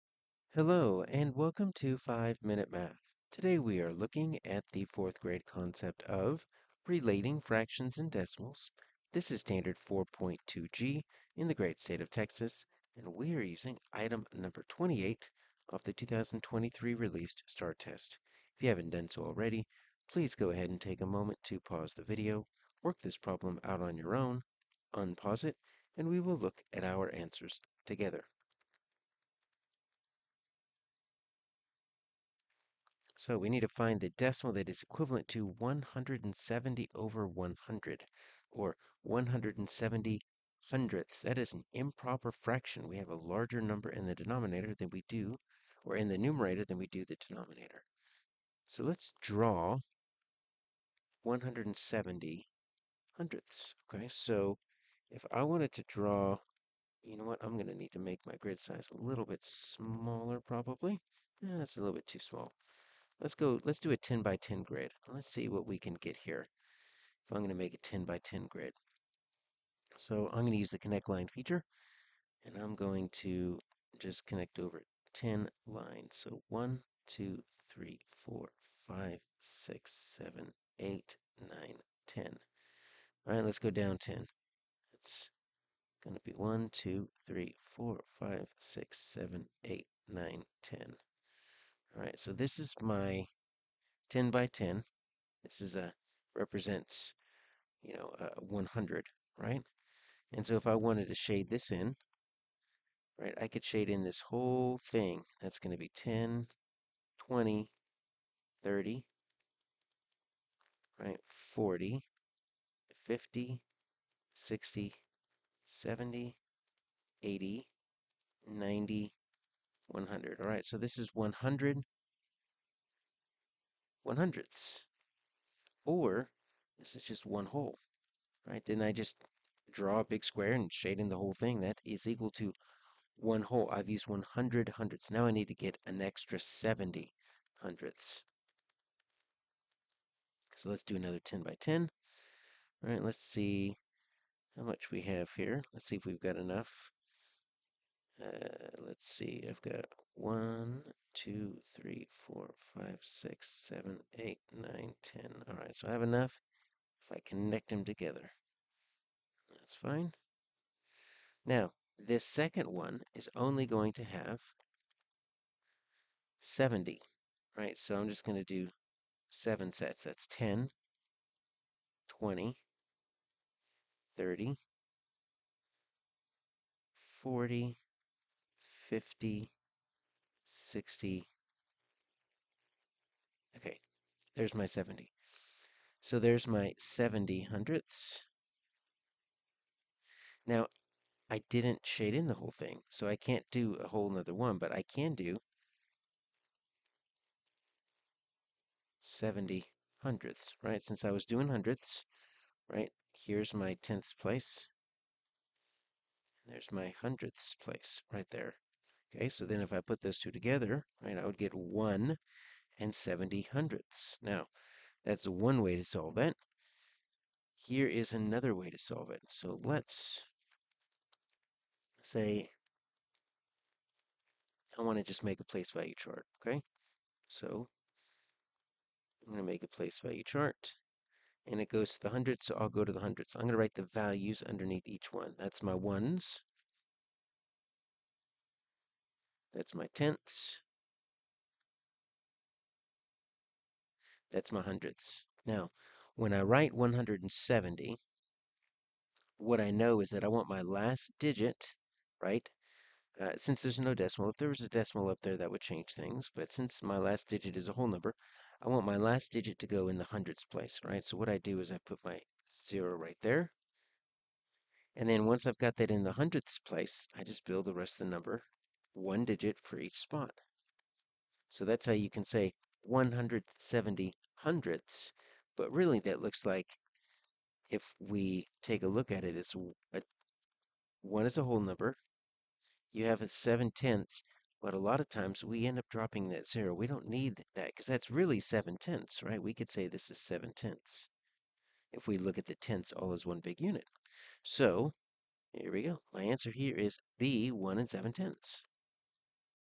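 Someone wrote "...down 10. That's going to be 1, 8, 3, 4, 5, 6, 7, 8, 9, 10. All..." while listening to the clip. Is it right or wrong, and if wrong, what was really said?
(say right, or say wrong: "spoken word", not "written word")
wrong: "2", not "8".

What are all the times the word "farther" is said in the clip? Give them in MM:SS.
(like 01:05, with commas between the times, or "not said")
not said.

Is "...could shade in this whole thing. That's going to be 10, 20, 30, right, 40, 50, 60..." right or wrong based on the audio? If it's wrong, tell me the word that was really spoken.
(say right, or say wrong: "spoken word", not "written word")
right.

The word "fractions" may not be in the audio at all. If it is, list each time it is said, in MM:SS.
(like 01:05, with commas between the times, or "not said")
00:07, 00:42.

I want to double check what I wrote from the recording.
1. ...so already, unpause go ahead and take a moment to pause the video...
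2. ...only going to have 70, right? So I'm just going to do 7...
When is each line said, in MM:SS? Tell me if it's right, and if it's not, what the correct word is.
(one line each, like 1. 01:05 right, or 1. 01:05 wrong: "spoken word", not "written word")
1. 00:19 wrong: "please", not "unpause"
2. 02:43 right.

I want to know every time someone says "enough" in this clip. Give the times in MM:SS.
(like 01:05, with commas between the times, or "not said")
02:26, 02:36.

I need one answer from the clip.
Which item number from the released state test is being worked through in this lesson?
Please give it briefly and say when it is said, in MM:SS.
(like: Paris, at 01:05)
28, at 00:14.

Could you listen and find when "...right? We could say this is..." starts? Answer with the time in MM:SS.
04:49.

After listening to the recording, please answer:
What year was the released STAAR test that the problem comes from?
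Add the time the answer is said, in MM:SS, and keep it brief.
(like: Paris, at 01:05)
2023, at 00:15.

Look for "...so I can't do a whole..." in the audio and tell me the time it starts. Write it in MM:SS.
03:12.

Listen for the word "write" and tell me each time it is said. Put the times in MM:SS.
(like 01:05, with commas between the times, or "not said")
03:53, 04:06.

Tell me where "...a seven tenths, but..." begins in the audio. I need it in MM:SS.
04:43.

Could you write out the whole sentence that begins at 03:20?
Since I was doing hundredths, right?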